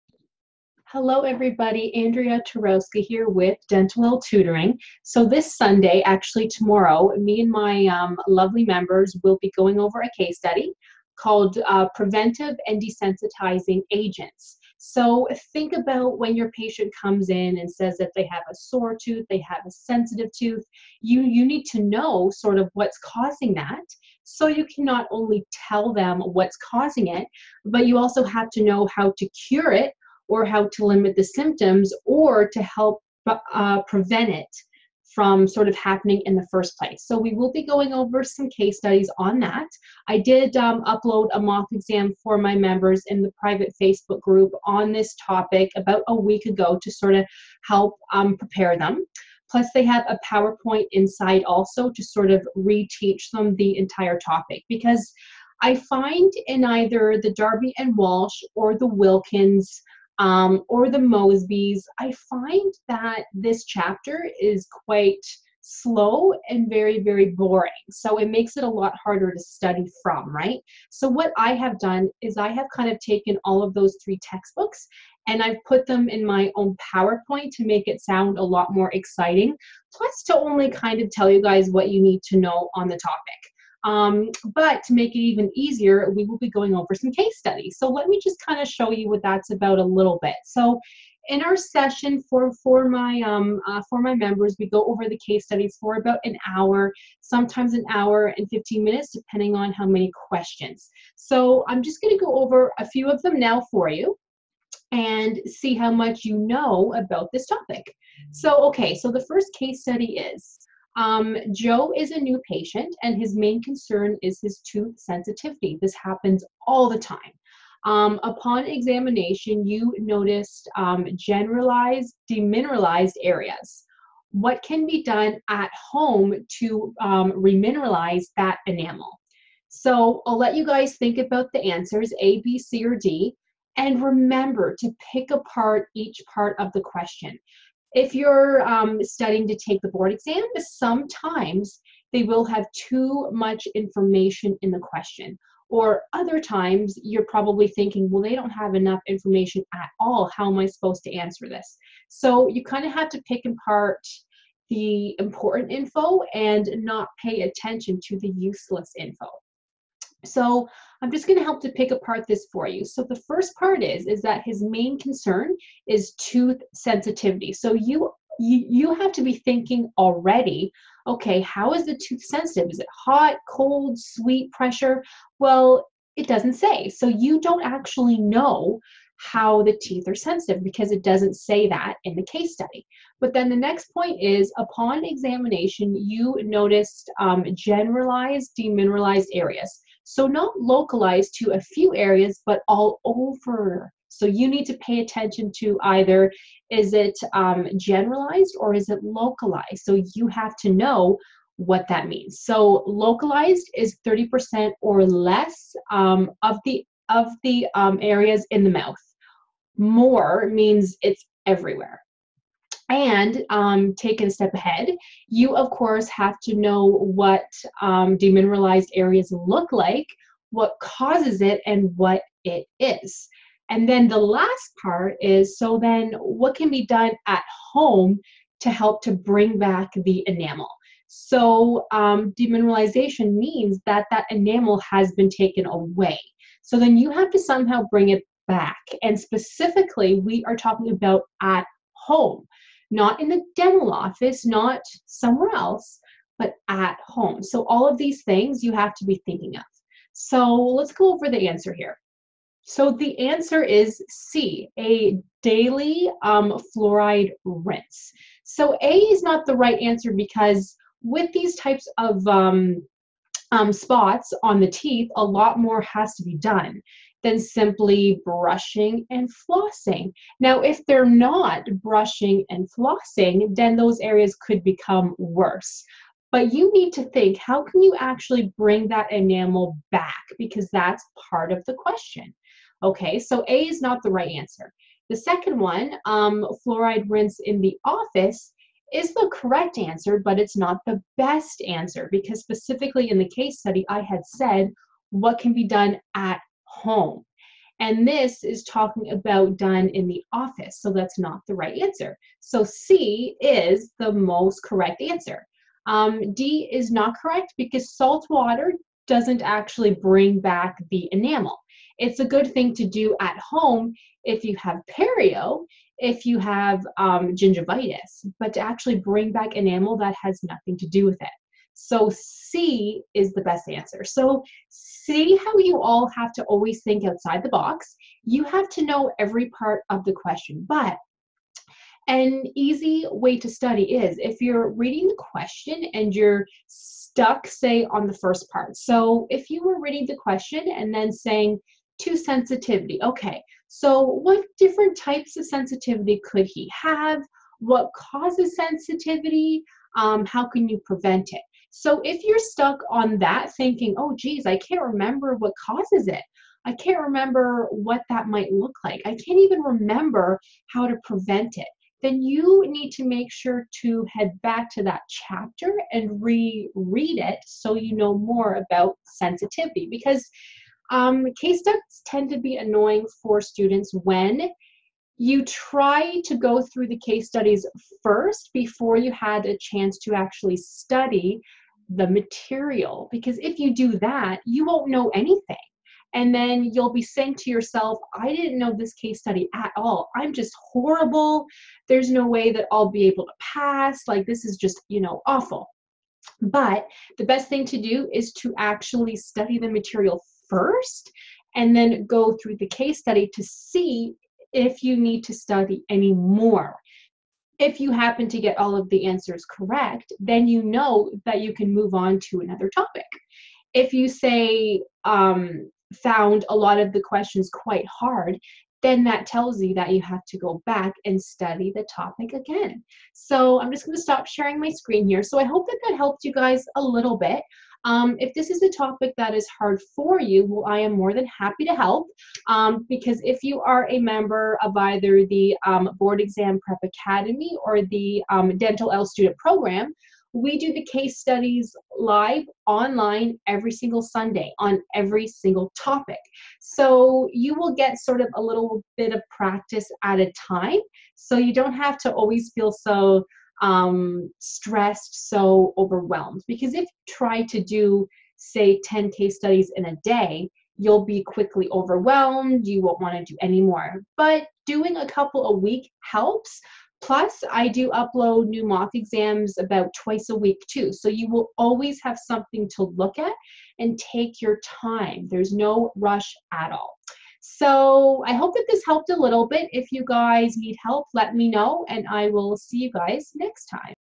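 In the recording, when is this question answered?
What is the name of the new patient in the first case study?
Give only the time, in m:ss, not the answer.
1:51.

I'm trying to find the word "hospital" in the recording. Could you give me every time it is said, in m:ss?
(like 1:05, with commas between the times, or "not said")
not said.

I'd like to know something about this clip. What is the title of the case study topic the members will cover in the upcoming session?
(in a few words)
Preventive and Desensitizing Agents.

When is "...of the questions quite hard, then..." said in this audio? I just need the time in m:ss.
6:56.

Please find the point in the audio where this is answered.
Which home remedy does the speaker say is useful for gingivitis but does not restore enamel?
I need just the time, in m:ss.
5:07.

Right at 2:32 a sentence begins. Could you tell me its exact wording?
So you kind of have to pick and part the important info and not pay attention to the useless info.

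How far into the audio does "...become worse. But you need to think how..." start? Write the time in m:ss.
4:34.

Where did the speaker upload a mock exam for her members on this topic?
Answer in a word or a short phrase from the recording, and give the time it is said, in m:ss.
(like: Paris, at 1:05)
private Facebook group, at 0:43.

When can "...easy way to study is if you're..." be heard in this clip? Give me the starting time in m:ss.
5:32.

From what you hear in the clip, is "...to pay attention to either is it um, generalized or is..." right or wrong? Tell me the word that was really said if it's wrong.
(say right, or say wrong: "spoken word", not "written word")
right.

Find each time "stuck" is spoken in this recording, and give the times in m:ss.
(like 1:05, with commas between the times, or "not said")
5:36, 5:52.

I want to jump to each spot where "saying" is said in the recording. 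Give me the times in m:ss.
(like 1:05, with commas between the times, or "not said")
5:41, 6:27.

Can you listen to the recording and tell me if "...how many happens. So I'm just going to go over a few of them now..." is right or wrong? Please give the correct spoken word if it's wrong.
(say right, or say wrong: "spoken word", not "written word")
wrong: "questions", not "happens".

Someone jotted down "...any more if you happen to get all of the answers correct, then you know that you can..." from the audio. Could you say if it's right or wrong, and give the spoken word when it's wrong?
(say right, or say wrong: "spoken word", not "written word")
right.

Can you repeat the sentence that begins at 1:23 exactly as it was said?
Um, but to make it even easier, we will be going over some case studies.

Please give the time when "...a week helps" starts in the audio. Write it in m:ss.
7:45.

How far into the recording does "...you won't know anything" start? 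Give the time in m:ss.
6:24.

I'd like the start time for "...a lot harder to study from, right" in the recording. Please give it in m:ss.
1:08.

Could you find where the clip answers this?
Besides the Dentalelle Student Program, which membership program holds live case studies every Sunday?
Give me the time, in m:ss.
7:15.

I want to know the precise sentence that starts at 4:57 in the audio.
And this is talking about done in the office.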